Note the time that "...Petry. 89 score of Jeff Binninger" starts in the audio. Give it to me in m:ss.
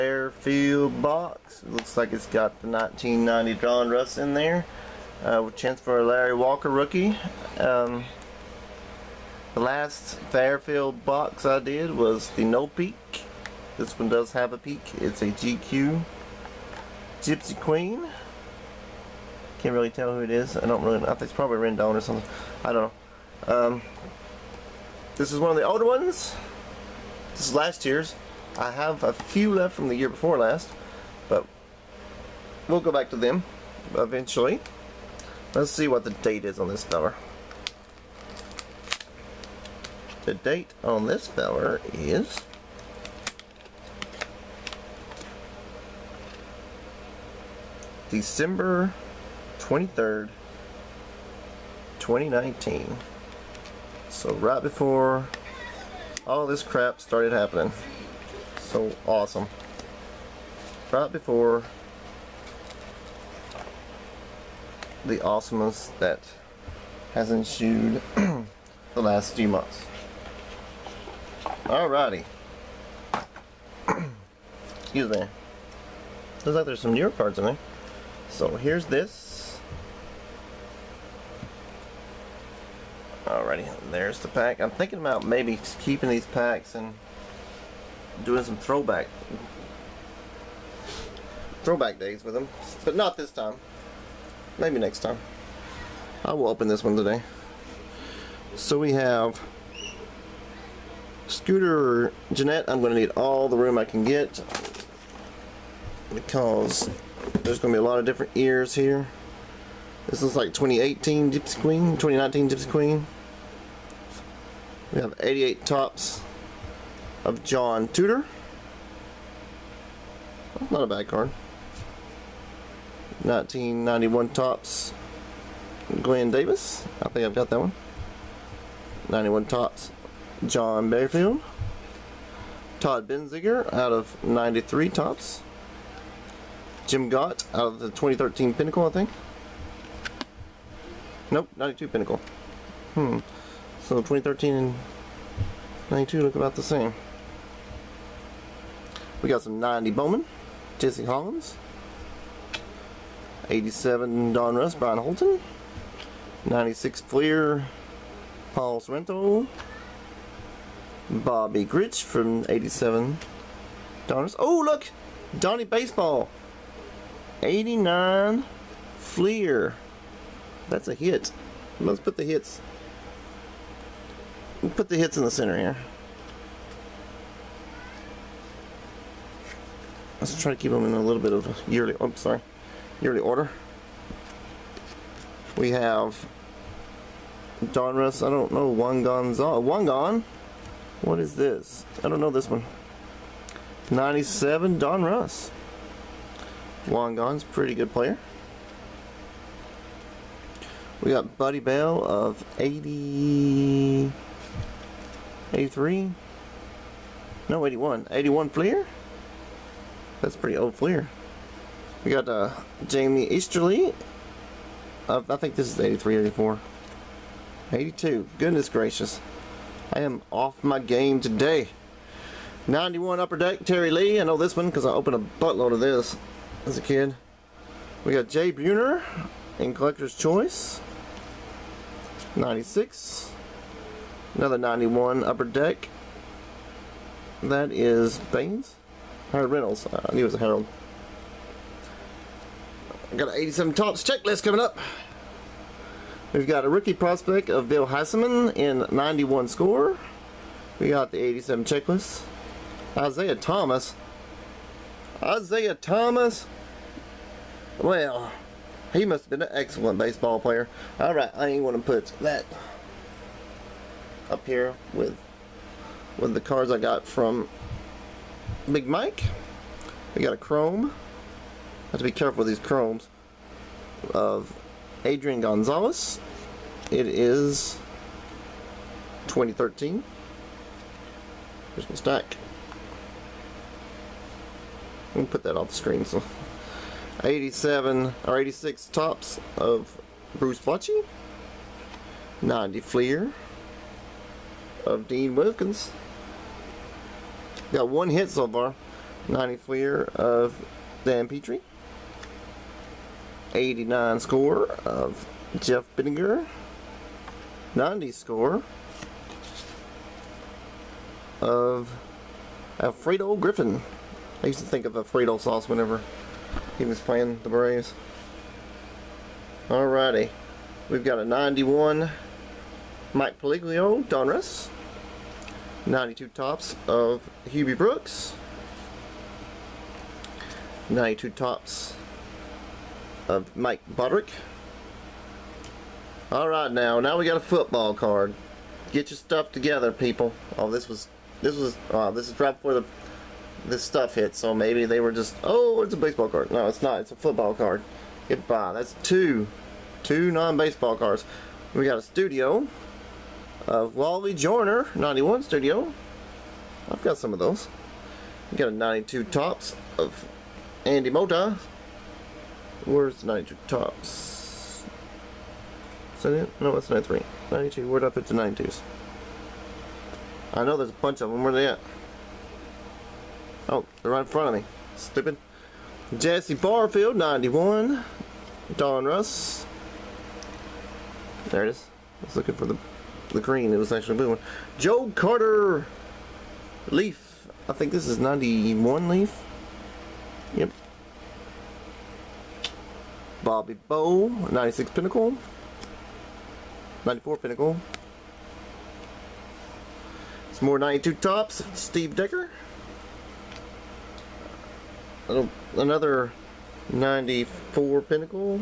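5:01.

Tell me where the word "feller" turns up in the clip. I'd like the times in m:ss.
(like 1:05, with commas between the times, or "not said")
0:36, 0:41.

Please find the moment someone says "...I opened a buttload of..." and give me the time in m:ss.
3:44.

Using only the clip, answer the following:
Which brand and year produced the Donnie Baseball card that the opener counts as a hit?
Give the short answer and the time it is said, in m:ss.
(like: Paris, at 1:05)
89 Fleer, at 2:47.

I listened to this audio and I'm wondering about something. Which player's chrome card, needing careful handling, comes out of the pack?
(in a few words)
Adrian Gonzalez.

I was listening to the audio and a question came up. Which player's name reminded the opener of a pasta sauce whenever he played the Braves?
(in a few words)
Alfredo Griffin.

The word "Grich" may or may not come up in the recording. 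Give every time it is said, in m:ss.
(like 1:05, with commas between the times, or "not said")
2:41.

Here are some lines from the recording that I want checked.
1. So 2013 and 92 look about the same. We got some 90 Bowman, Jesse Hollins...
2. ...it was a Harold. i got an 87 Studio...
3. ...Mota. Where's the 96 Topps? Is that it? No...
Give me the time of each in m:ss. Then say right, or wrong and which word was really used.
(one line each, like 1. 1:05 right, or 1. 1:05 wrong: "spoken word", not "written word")
1. 2:23 right
2. 4:00 wrong: "Topps", not "Studio"
3. 6:01 wrong: "92", not "96".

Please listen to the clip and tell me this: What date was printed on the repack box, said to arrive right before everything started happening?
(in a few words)
December 23rd, 2019.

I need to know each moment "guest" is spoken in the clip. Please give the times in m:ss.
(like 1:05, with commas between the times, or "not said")
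not said.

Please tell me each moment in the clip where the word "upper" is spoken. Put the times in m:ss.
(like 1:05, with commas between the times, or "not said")
3:43, 3:55.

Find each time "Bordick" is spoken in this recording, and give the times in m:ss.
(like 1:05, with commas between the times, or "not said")
5:33.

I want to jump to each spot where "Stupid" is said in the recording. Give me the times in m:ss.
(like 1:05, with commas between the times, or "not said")
6:14.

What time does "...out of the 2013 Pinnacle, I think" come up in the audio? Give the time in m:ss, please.
2:17.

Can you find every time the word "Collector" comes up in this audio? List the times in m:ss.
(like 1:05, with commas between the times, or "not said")
3:49.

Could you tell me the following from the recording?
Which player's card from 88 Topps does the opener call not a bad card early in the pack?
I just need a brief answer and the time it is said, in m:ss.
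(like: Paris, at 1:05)
John Tudor, at 1:57.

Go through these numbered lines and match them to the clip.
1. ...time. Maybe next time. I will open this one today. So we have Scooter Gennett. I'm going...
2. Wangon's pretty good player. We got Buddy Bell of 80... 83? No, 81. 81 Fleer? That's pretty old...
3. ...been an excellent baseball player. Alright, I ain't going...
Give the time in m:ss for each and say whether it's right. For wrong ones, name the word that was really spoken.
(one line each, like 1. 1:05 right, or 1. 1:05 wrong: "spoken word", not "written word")
1. 1:33 right
2. 3:16 right
3. 4:19 right.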